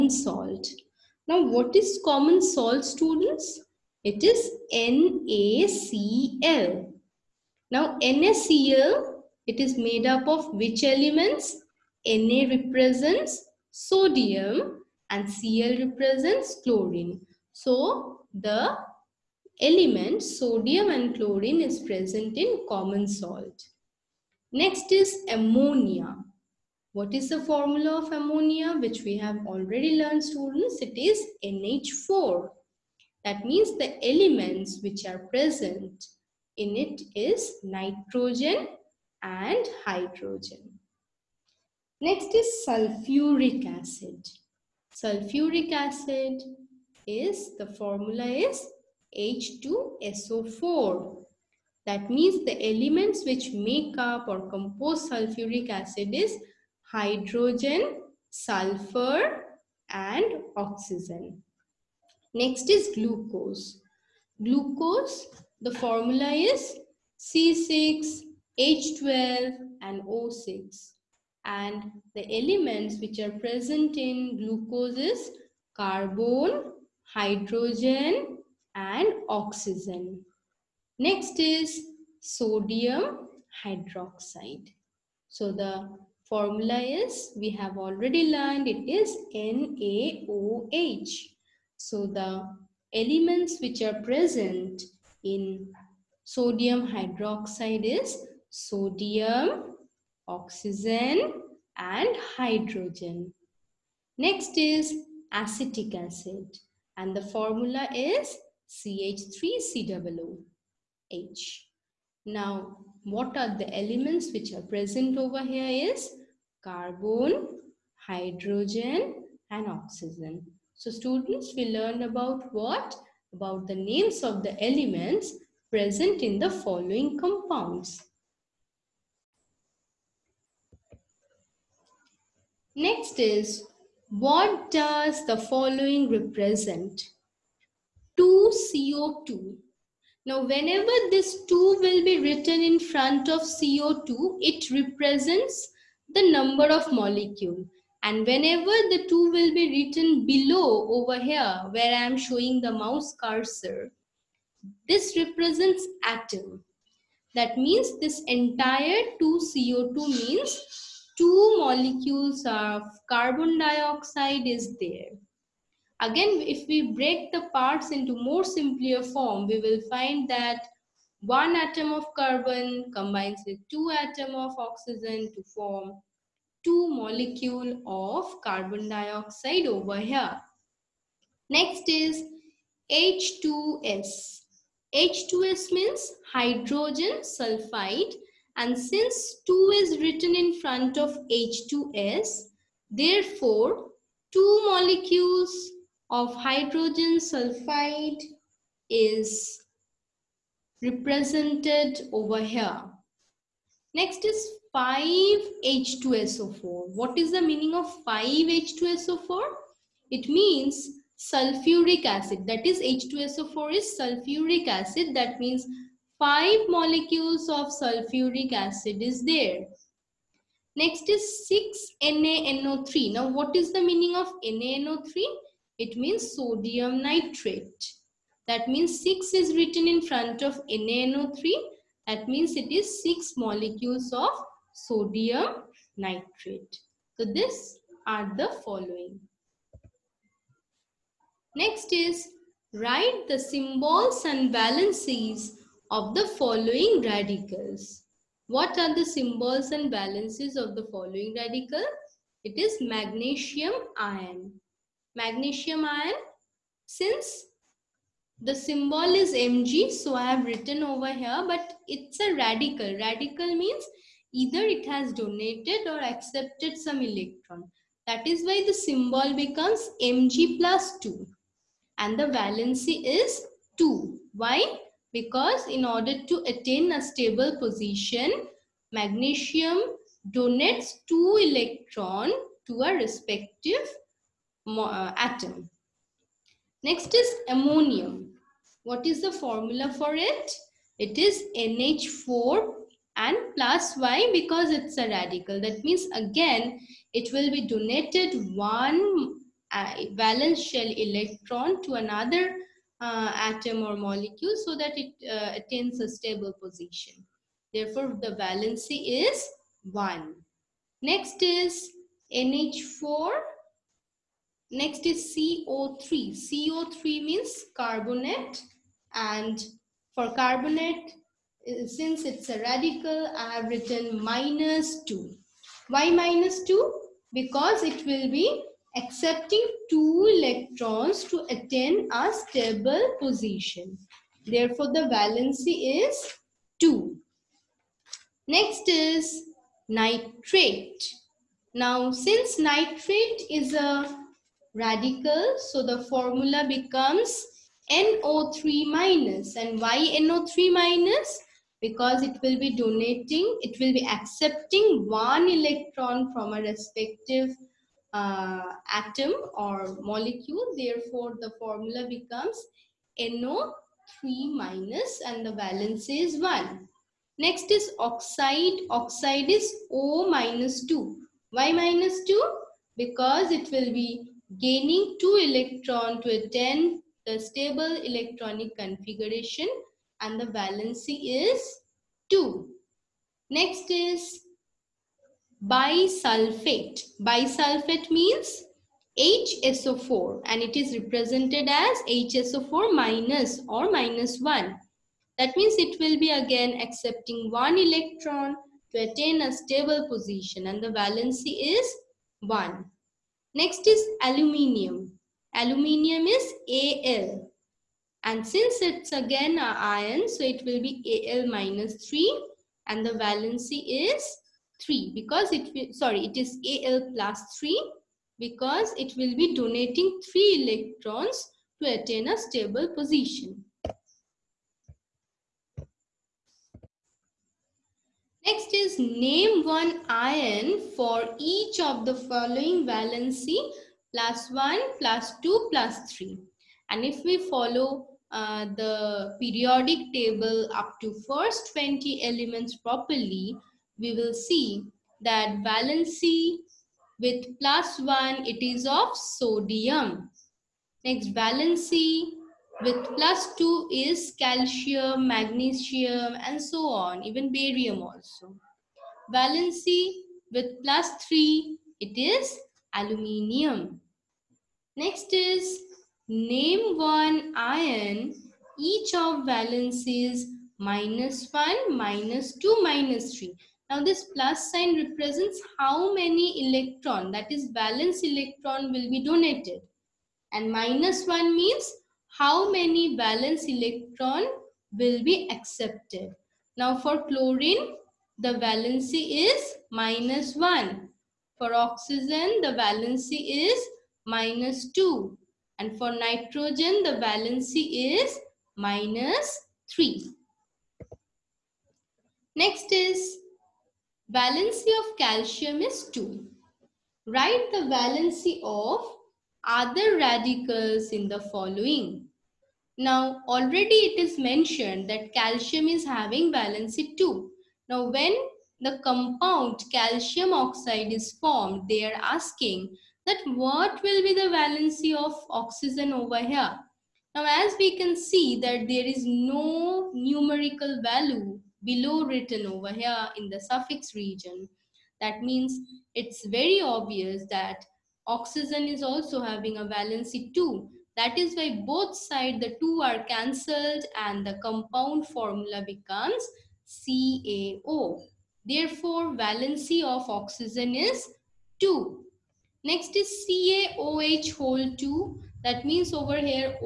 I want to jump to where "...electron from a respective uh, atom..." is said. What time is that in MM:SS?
05:55.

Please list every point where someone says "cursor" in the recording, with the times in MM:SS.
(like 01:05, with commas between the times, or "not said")
02:33.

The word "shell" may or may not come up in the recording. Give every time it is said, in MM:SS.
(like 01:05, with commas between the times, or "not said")
05:00.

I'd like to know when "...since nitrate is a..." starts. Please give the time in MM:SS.
05:42.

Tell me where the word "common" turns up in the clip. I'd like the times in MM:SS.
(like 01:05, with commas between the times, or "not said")
00:02, 00:22.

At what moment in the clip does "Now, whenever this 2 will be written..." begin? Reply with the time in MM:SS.
02:20.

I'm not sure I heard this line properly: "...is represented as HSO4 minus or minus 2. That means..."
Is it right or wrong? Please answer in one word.
wrong.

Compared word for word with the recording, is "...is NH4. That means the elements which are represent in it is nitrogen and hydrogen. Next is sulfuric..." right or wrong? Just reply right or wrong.
wrong.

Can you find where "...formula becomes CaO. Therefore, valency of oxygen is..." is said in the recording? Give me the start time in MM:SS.
09:05.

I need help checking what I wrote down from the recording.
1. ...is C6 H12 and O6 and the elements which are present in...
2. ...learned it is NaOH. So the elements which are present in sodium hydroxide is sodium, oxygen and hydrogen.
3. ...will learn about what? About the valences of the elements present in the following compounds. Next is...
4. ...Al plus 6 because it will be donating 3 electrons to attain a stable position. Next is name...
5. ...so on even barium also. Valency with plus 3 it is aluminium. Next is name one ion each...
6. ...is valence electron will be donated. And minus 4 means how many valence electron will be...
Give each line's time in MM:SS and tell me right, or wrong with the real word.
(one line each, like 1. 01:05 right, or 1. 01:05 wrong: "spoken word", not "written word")
1. 01:06 right
2. 01:28 right
3. 02:01 wrong: "names", not "valences"
4. 06:56 wrong: "3", not "6"
5. 07:36 right
6. 07:57 wrong: "1", not "4".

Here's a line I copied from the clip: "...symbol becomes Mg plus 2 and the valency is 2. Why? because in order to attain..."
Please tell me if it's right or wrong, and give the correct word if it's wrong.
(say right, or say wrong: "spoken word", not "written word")
right.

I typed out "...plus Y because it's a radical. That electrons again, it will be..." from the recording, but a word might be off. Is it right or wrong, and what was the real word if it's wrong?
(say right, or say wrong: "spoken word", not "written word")
wrong: "means", not "electrons".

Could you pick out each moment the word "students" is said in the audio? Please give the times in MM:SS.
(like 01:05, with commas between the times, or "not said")
00:02, 00:30, 02:00.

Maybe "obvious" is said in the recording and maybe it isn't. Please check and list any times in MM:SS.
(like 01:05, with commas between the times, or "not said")
08:56.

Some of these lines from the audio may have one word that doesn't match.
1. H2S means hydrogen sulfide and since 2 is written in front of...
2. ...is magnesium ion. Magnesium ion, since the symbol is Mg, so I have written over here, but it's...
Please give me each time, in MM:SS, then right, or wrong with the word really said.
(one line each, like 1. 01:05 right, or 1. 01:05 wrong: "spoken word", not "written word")
1. 03:04 right
2. 04:12 right.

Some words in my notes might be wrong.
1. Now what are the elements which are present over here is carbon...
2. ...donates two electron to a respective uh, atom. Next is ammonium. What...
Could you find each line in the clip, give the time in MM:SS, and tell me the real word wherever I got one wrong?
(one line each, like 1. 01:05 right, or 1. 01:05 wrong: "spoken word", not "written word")
1. 01:52 right
2. 04:40 right.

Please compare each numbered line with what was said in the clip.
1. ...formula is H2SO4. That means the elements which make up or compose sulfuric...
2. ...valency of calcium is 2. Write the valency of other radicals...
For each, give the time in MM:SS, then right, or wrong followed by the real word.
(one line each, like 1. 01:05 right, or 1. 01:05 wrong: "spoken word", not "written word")
1. 00:47 right
2. 08:24 right.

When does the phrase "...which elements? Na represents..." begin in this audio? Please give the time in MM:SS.
00:10.